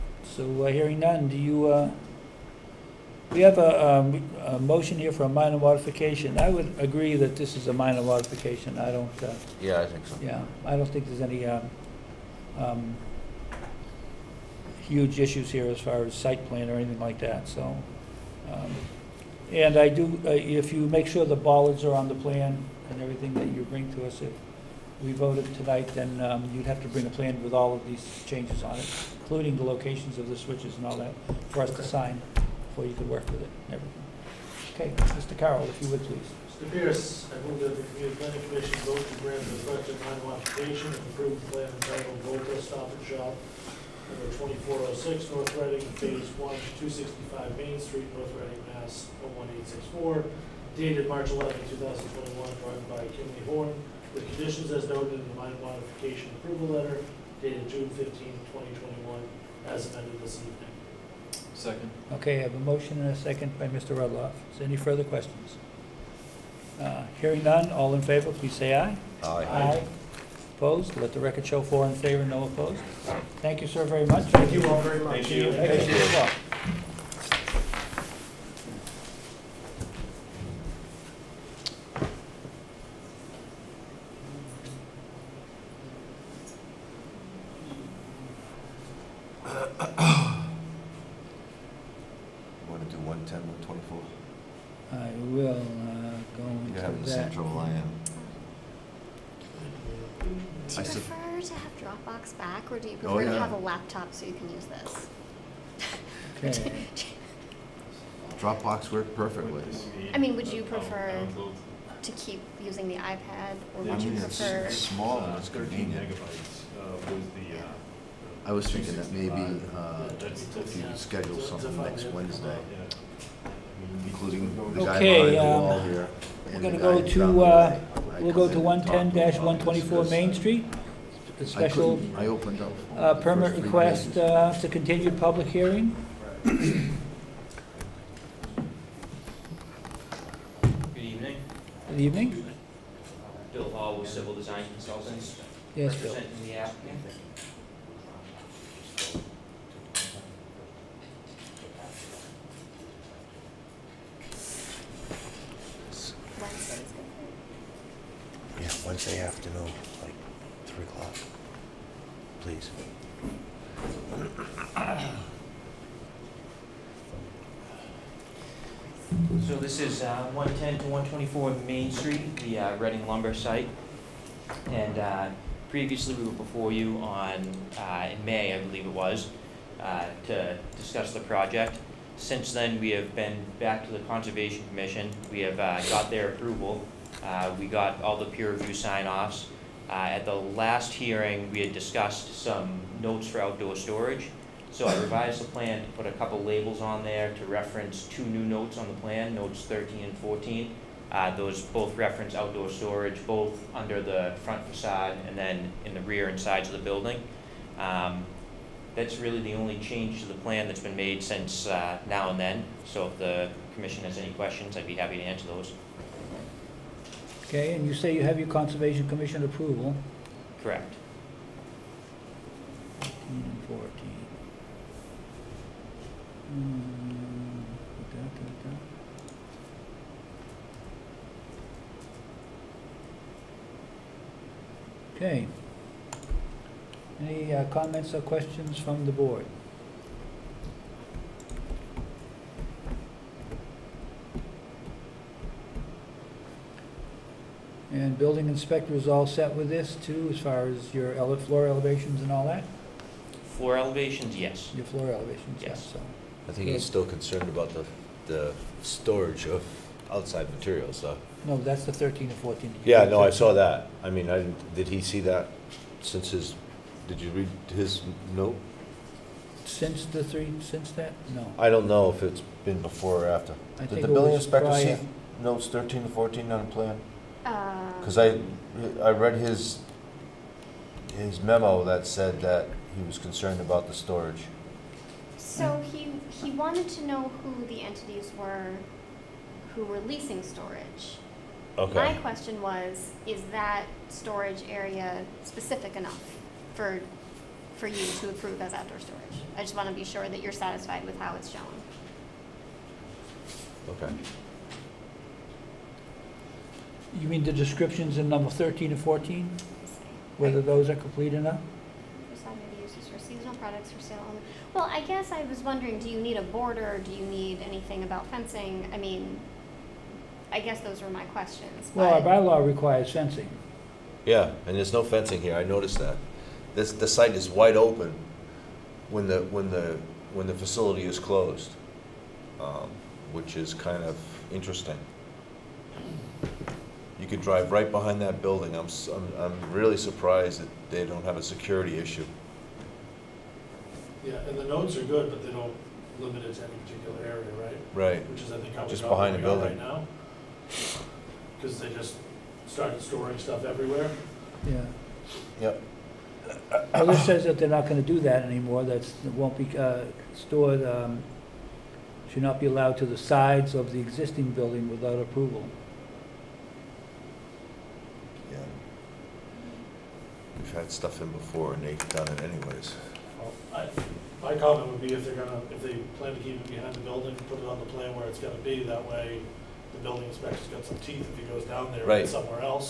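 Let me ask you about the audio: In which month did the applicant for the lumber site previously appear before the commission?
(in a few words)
May.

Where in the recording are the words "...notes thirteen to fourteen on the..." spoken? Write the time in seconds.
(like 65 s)
275 s.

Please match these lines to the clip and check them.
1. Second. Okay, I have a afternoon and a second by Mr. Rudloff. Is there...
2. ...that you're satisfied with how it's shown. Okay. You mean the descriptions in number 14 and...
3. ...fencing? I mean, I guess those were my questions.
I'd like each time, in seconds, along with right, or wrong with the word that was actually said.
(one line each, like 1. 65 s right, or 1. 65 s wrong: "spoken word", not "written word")
1. 61 s wrong: "motion", not "afternoon"
2. 300 s wrong: "13", not "14"
3. 318 s right.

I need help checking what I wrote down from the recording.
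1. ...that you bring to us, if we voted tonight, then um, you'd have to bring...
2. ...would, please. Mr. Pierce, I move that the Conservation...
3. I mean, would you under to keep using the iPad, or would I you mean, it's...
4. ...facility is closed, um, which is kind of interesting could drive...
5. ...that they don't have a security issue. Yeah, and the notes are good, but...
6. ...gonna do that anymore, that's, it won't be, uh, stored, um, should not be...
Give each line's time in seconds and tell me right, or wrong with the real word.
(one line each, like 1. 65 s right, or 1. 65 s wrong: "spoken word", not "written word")
1. 23 s right
2. 35 s wrong: "Community", not "Conservation"
3. 110 s wrong: "prefer", not "under"
4. 330 s right
5. 340 s right
6. 357 s right.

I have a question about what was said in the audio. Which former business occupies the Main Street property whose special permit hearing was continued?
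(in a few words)
Reading lumber.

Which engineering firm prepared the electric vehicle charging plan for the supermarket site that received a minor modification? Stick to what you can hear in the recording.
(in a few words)
Kimley Horn.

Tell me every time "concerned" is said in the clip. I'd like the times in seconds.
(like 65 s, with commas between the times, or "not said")
257 s, 283 s.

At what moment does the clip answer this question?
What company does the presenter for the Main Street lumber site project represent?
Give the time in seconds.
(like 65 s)
144 s.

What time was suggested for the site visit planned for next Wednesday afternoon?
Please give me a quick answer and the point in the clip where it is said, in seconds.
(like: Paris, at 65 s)
3 o'clock, at 160 s.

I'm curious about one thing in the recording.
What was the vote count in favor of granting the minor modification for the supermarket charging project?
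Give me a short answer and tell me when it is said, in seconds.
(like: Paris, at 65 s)
4, at 71 s.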